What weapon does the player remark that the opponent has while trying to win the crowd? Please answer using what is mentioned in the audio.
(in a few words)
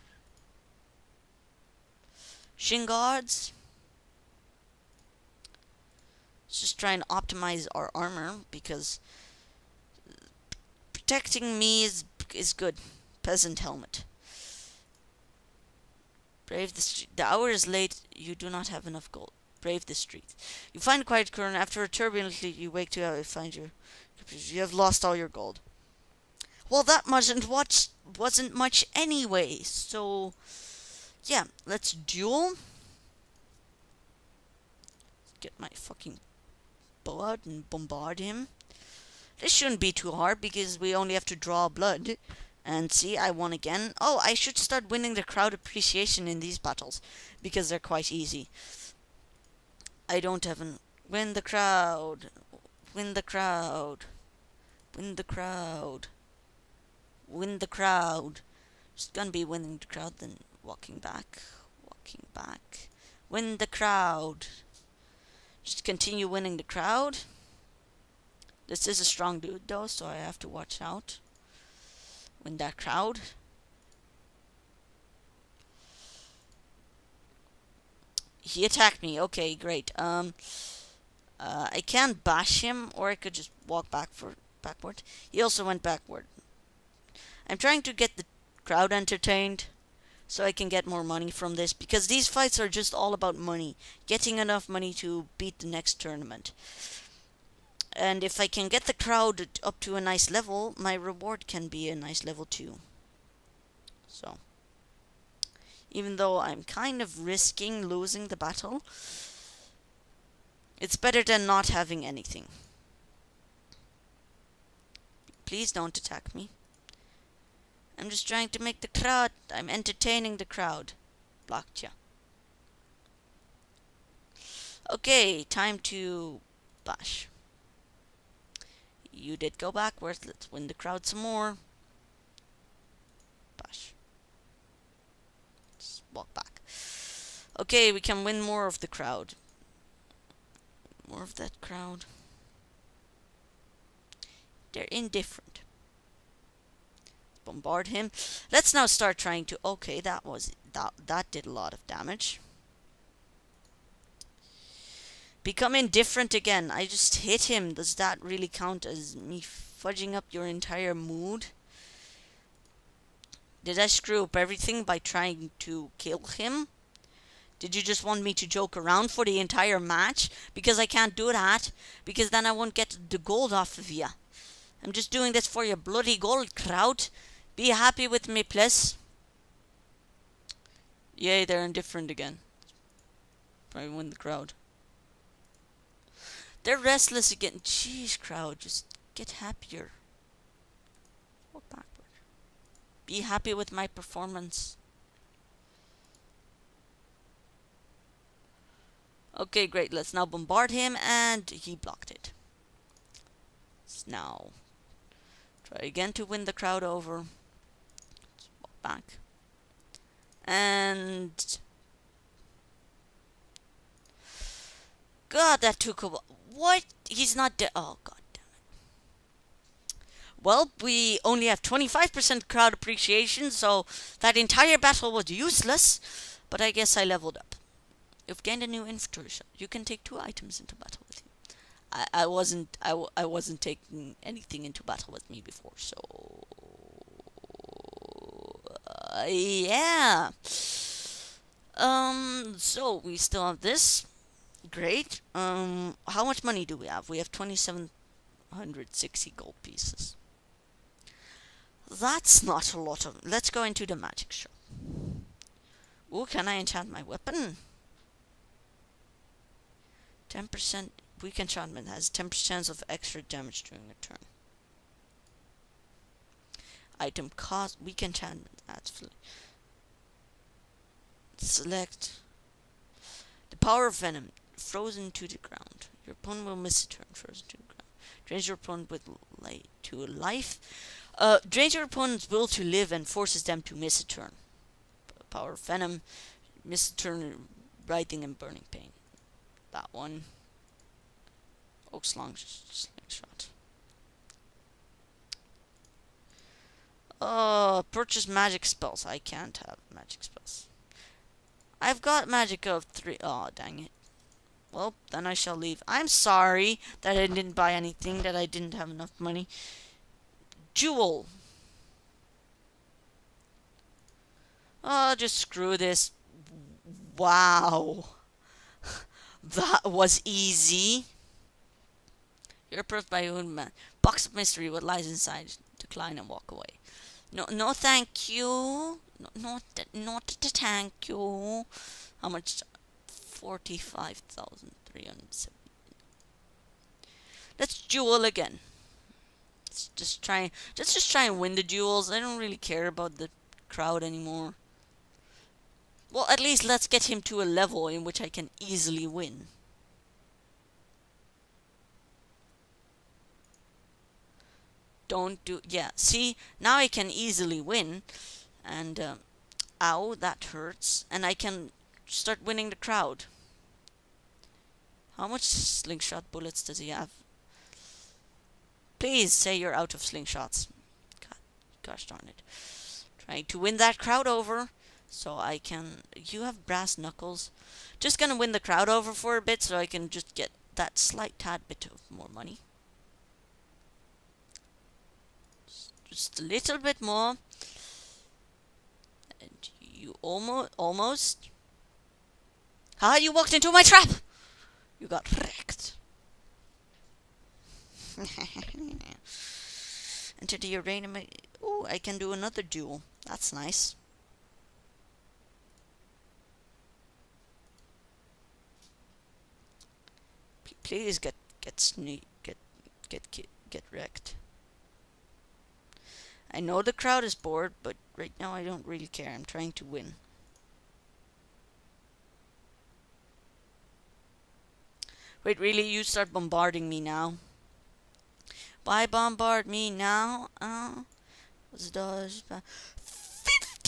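Brass knuckles.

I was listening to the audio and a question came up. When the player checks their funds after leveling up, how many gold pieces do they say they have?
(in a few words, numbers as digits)
2,760.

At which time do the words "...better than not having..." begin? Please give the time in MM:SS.
01:50.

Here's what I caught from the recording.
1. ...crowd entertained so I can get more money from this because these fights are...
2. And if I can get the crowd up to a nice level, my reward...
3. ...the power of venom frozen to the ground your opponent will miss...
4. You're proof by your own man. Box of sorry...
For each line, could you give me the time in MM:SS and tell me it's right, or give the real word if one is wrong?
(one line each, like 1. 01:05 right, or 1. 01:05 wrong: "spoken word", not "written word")
1. 01:28 right
2. 01:37 right
3. 04:33 right
4. 05:22 wrong: "mystery", not "sorry".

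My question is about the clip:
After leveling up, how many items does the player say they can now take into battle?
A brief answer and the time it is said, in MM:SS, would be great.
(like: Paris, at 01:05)
2, at 03:50.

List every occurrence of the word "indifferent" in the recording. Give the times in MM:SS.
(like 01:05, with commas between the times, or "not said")
02:24, 02:35, 03:01.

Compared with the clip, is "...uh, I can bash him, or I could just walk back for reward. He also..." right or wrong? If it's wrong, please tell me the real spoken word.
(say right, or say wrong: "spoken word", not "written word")
wrong: "backward", not "reward".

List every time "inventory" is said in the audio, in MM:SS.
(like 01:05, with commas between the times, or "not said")
03:48.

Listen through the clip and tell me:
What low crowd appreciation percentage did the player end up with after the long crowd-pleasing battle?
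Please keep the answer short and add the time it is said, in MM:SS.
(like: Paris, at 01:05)
25%, at 03:41.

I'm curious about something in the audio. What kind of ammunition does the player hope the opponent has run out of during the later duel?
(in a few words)
Slingshot bullets.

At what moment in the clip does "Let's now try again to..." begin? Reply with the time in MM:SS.
03:23.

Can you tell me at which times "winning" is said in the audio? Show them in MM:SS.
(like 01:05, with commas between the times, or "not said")
00:44, 00:59, 01:06, 06:02.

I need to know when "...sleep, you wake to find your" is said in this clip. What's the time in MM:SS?
00:22.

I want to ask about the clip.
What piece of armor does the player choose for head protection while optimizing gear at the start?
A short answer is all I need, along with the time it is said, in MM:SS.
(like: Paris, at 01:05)
Peasant helmet, at 00:13.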